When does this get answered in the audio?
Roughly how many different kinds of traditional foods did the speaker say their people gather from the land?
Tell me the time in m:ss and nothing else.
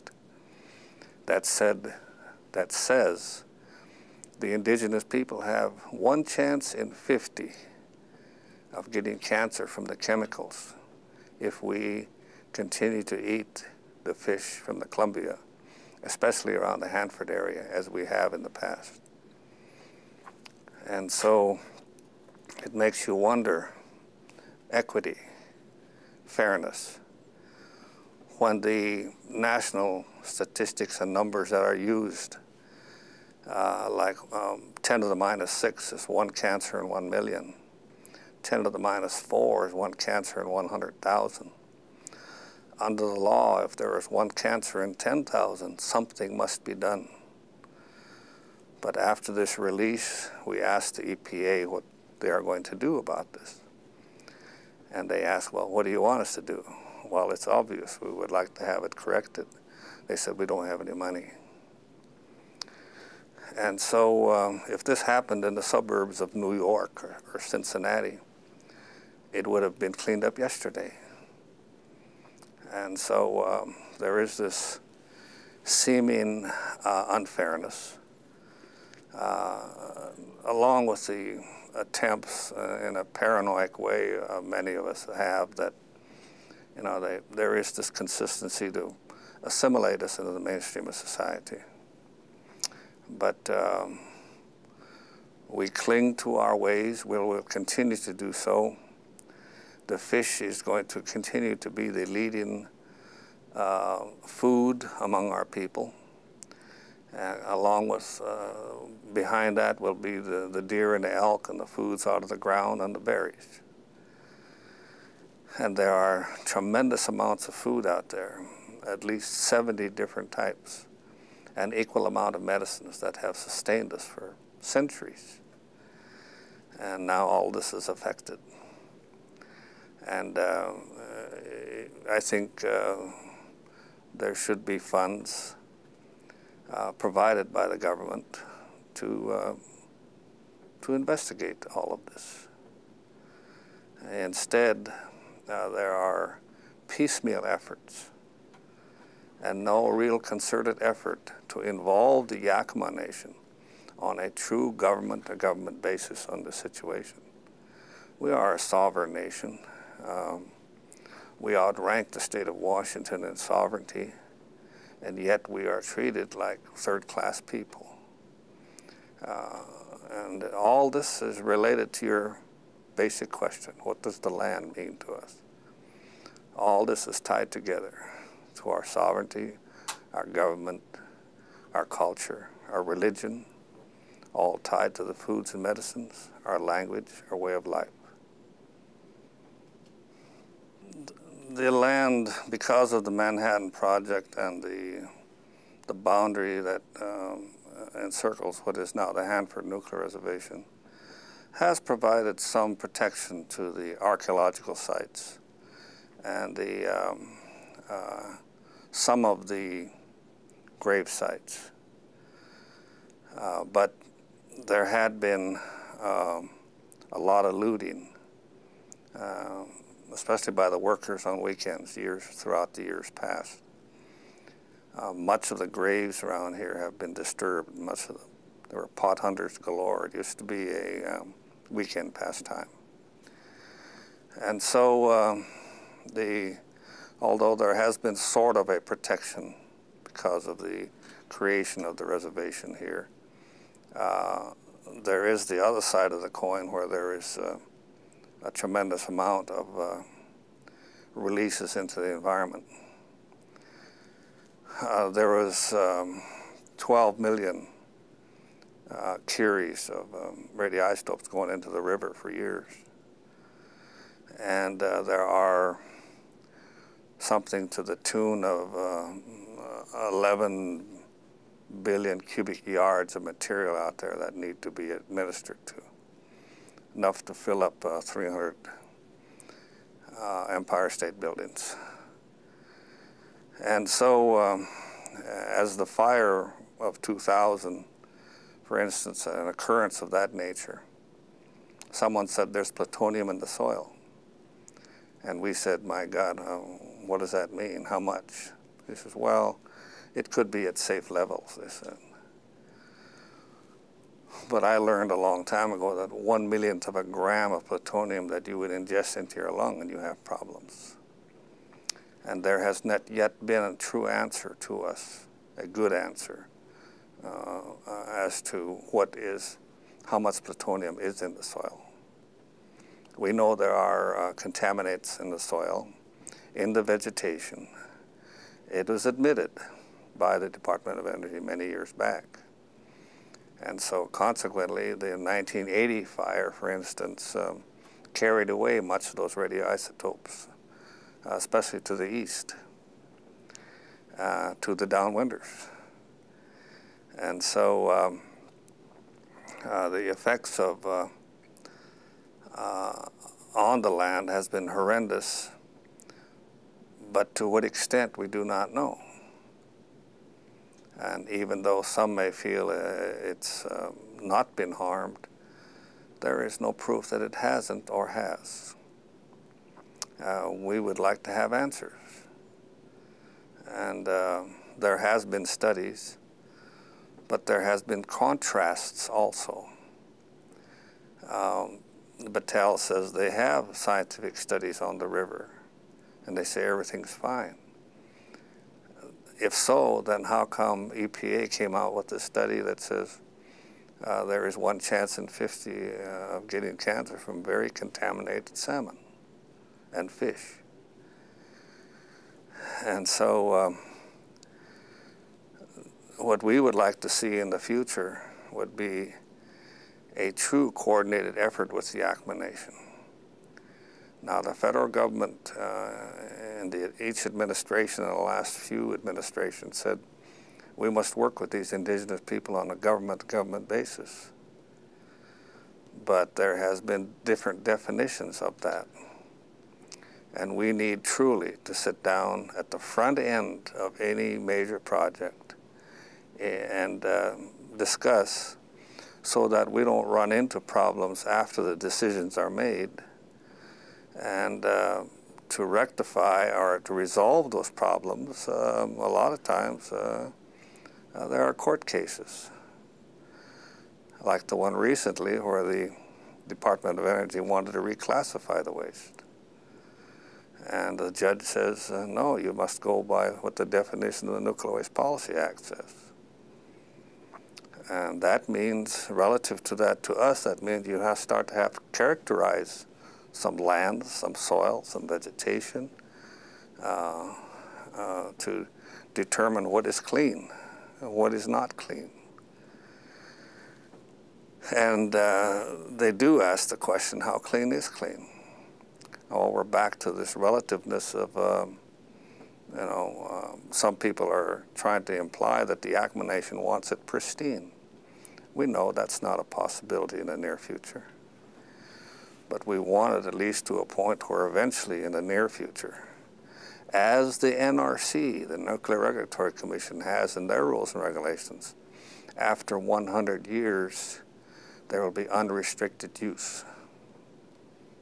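1:59.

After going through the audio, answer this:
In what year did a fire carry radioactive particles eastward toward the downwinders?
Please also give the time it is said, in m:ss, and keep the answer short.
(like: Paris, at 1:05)
1980, at 5:35.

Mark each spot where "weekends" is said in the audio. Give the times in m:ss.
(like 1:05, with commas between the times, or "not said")
3:41, 3:51.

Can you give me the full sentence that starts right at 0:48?
But after this release, we asked the EPA what they are going to do about this.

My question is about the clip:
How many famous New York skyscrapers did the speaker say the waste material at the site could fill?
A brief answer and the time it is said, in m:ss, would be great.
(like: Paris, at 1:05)
300, at 4:38.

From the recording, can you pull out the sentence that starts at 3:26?
And the, um, uh, some of the grave sites.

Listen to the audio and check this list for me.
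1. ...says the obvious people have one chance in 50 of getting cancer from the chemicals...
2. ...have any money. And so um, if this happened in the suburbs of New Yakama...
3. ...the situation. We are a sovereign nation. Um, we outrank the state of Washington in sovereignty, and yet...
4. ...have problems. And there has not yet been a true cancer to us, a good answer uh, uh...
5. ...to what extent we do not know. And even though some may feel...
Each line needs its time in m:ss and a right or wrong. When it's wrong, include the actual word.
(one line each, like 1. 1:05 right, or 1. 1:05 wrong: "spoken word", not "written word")
1. 0:02 wrong: "indigenous", not "obvious"
2. 1:00 wrong: "York", not "Yakama"
3. 2:36 right
4. 5:09 wrong: "answer", not "cancer"
5. 5:57 right.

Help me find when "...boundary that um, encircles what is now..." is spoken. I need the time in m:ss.
3:15.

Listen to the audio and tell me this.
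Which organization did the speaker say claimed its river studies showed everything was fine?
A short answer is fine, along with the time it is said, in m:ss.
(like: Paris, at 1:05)
Battelle, at 6:22.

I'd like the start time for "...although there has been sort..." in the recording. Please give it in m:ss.
3:57.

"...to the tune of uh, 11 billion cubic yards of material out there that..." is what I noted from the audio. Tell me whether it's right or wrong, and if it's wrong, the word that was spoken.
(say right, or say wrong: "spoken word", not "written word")
right.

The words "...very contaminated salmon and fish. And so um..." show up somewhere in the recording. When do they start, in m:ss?
6:37.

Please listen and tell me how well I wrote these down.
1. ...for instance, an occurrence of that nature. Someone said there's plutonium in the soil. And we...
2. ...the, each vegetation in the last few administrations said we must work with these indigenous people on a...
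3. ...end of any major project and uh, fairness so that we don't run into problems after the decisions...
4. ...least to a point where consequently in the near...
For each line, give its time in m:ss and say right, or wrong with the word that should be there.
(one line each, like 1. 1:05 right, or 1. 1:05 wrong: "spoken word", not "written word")
1. 4:48 right
2. 6:56 wrong: "administration", not "vegetation"
3. 7:13 wrong: "discuss", not "fairness"
4. 8:23 wrong: "eventually", not "consequently".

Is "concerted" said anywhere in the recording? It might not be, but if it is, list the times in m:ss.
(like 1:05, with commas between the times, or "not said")
2:30.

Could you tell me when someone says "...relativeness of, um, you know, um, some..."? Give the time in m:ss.
8:10.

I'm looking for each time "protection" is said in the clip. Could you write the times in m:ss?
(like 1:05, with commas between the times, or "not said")
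3:22, 3:58.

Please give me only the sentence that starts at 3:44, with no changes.
Uh, much of the graves around here have been disturbed.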